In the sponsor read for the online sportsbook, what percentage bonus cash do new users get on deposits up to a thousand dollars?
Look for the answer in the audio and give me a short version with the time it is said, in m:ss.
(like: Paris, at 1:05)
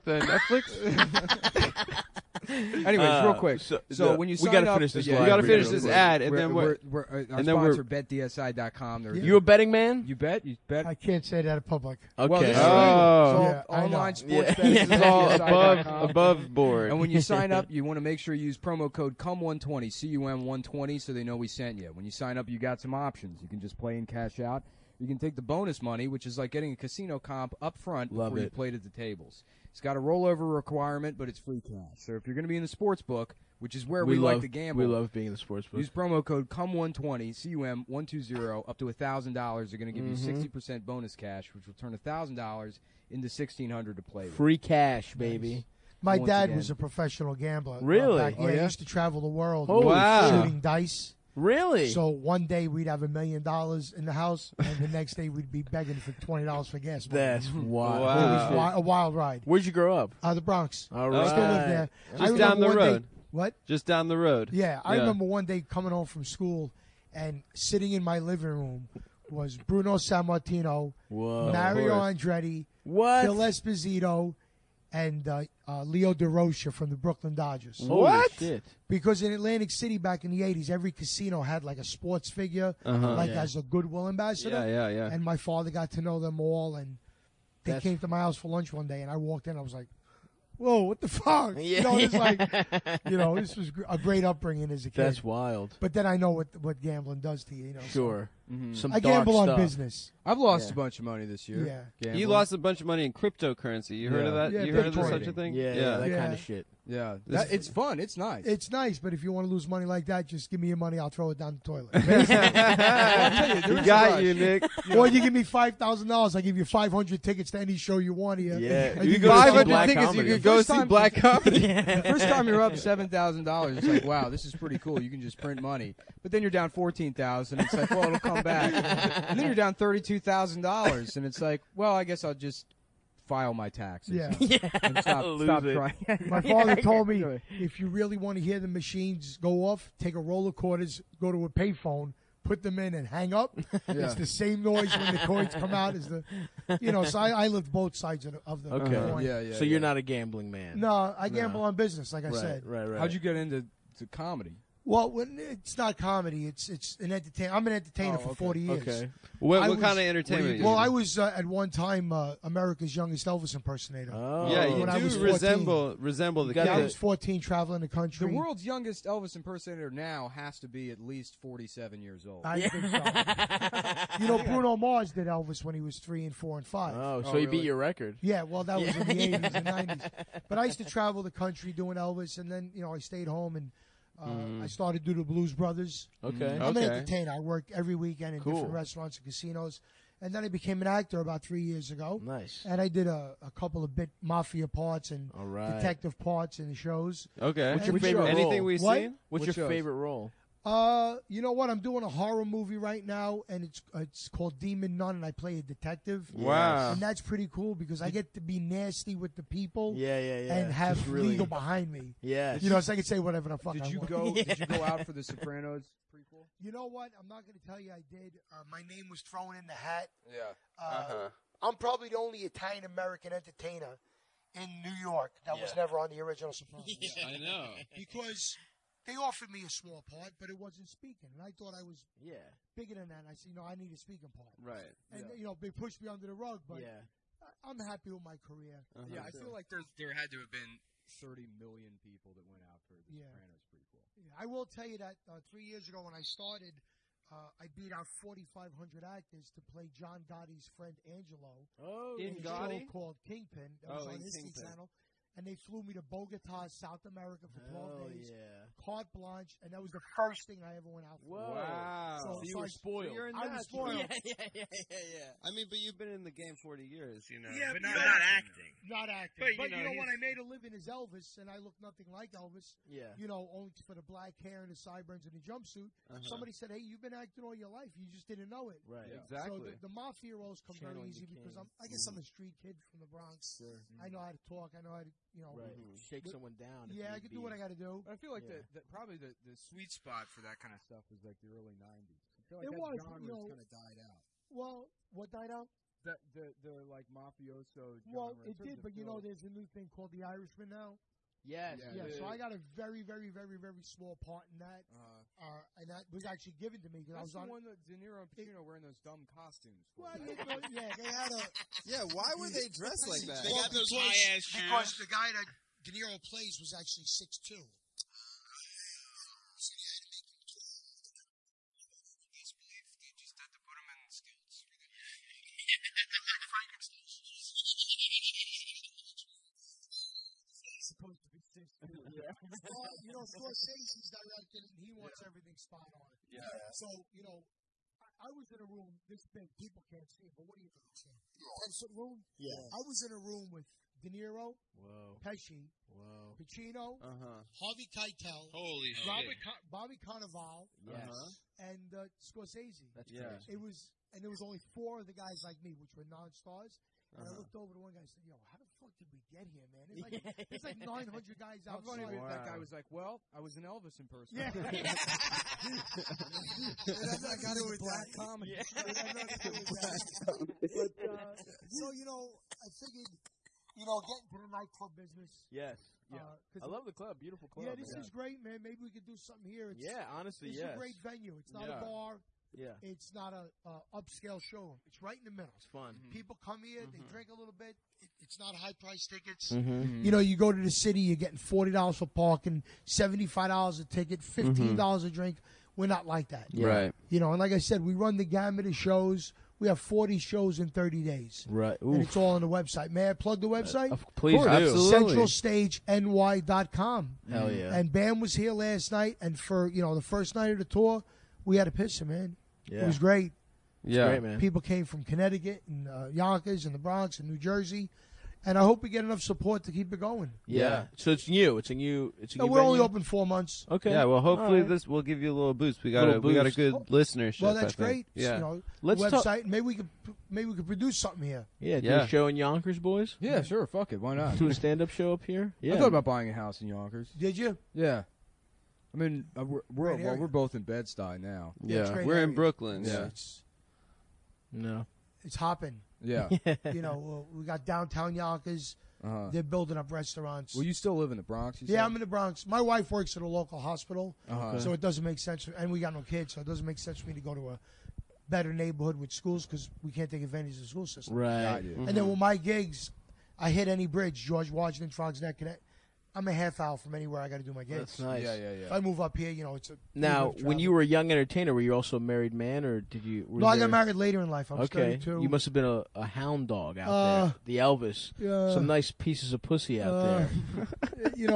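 60%, at 0:40.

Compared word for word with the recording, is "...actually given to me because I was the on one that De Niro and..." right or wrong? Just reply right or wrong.
right.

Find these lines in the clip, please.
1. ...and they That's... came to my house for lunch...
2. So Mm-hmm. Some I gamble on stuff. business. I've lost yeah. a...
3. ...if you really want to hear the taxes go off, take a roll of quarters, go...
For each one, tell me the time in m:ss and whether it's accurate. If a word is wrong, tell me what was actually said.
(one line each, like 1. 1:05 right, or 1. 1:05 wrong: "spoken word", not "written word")
1. 1:26 right
2. 1:38 right
3. 2:17 wrong: "machines", not "taxes".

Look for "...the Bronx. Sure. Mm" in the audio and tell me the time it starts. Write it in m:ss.
4:43.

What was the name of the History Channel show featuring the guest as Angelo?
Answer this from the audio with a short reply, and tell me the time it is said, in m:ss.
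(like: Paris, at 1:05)
Kingpin, at 4:13.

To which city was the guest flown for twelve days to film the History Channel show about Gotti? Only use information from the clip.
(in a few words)
Bogota.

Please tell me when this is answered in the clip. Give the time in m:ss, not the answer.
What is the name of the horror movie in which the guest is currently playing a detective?
3:24.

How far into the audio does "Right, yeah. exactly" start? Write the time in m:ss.
4:38.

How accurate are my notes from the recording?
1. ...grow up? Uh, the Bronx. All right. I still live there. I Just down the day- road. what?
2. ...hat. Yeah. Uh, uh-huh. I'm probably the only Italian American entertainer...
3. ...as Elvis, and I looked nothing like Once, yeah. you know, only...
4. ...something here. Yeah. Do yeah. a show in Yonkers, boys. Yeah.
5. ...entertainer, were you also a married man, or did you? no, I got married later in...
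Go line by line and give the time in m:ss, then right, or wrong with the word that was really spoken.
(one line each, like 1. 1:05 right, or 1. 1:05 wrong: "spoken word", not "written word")
1. 0:59 right
2. 3:39 right
3. 4:30 wrong: "Elvis", not "Once"
4. 7:10 right
5. 7:51 right.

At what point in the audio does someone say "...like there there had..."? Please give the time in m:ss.
3:59.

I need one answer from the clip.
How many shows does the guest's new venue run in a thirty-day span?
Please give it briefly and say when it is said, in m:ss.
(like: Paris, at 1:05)
40, at 6:39.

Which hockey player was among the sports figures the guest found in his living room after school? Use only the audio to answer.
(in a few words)
Phil Esposito.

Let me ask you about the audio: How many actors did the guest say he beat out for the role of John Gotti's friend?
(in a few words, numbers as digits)
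4,500.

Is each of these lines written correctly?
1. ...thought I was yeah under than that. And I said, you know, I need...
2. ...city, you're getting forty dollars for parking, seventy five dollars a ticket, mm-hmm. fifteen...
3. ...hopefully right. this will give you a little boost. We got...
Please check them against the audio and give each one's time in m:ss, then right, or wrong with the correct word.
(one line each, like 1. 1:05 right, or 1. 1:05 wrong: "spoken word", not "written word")
1. 3:51 wrong: "bigger", not "under"
2. 6:30 right
3. 7:04 right.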